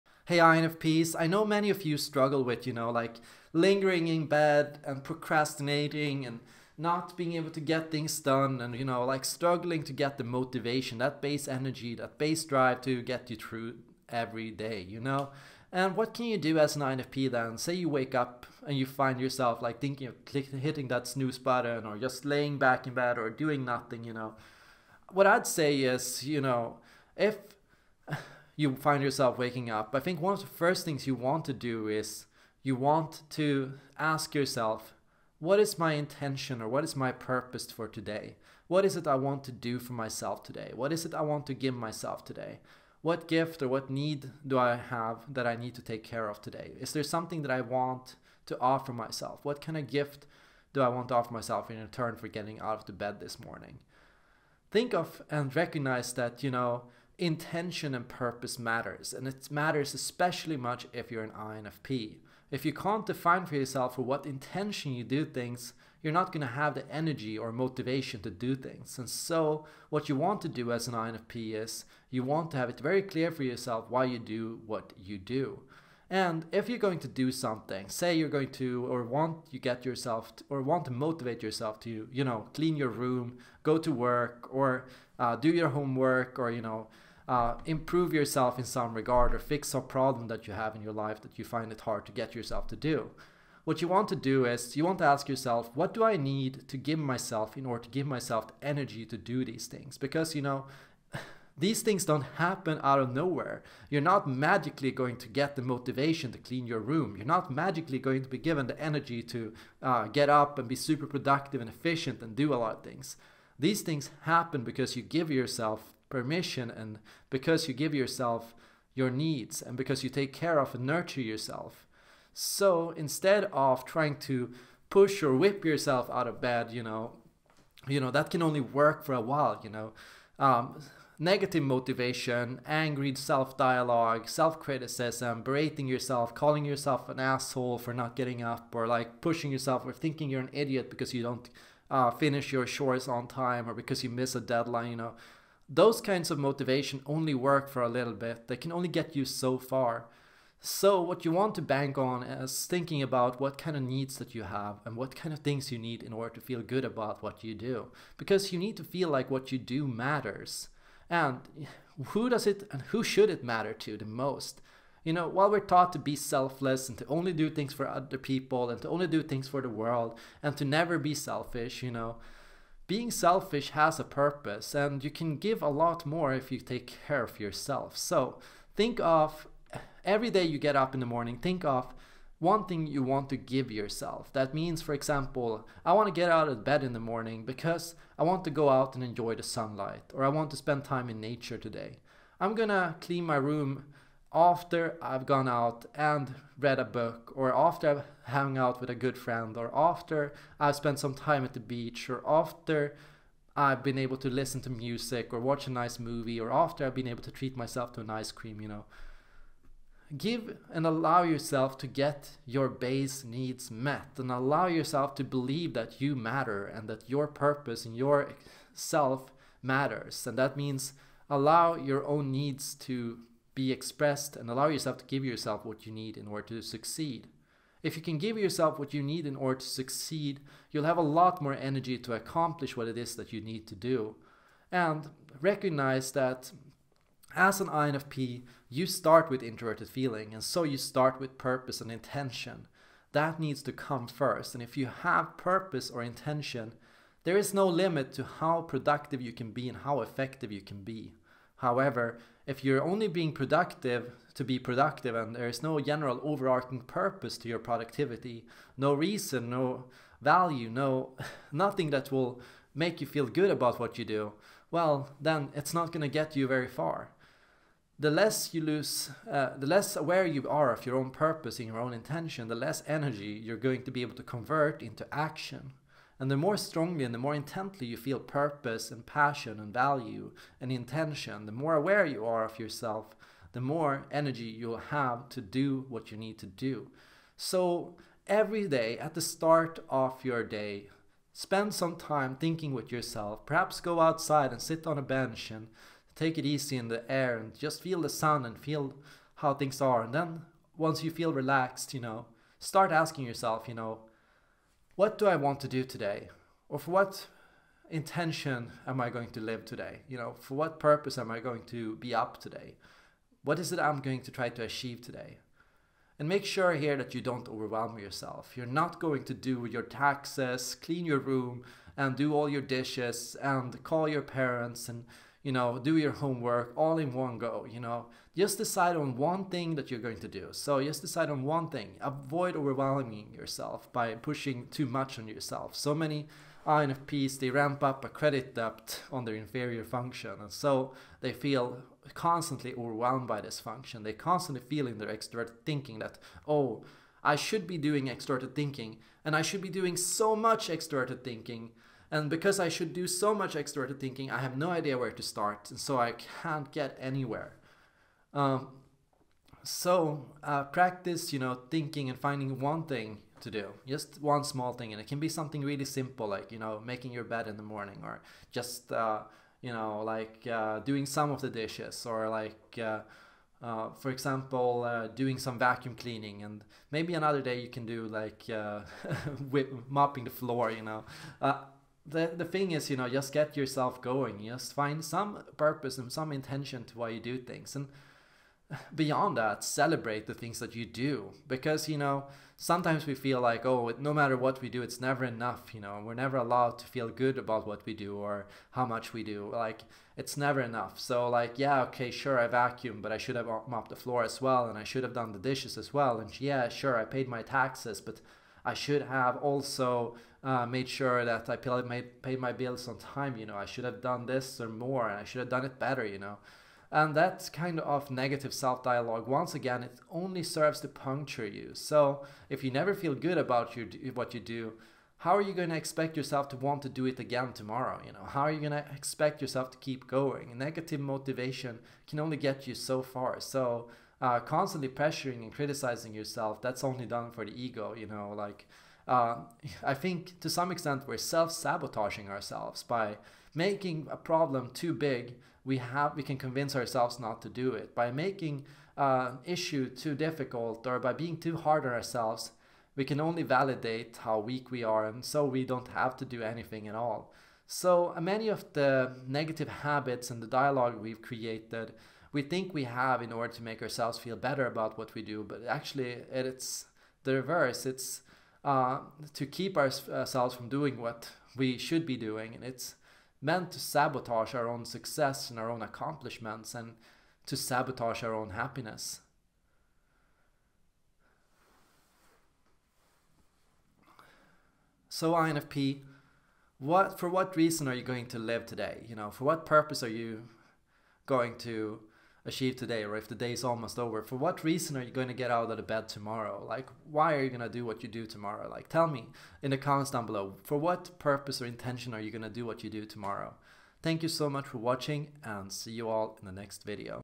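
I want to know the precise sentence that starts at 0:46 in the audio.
Is there something that I want to offer myself?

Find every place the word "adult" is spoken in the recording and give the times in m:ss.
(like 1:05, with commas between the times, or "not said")
not said.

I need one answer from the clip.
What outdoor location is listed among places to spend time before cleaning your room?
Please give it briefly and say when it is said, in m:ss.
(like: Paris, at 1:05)
the beach, at 3:21.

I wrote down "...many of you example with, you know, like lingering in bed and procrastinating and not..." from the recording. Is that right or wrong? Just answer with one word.
wrong.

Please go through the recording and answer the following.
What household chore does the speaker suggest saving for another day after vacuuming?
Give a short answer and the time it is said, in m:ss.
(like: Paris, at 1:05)
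mopping the floor, at 6:19.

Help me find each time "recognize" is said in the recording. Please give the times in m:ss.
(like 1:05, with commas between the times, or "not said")
0:55, 3:55.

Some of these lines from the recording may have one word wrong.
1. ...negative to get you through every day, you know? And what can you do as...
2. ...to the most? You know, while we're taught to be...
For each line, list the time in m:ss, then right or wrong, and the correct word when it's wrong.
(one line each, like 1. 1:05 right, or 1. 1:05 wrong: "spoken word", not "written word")
1. 0:12 wrong: "drive", not "negative"
2. 2:43 right.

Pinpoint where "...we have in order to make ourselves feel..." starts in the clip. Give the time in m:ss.
7:42.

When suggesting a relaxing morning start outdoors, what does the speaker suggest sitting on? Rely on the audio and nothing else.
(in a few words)
a bench.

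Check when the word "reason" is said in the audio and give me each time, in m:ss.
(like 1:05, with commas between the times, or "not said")
4:18, 8:07, 8:14.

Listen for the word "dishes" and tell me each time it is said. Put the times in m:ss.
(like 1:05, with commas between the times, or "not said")
5:22, 6:11, 6:45.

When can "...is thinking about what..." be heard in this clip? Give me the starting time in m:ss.
2:32.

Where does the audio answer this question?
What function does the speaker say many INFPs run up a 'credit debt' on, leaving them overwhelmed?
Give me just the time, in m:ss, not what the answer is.
5:39.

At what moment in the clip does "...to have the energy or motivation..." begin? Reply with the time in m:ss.
1:06.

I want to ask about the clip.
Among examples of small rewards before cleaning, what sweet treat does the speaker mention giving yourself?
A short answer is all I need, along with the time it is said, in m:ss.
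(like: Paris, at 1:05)
ice cream, at 3:28.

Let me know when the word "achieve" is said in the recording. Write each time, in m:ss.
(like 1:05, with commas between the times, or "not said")
5:14, 8:12.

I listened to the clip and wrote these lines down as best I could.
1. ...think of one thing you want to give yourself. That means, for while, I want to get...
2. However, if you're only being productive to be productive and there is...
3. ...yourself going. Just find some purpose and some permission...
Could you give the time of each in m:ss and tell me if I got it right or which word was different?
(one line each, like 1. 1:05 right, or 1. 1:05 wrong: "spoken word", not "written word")
1. 3:01 wrong: "example", not "while"
2. 4:11 right
3. 6:23 wrong: "intention", not "permission".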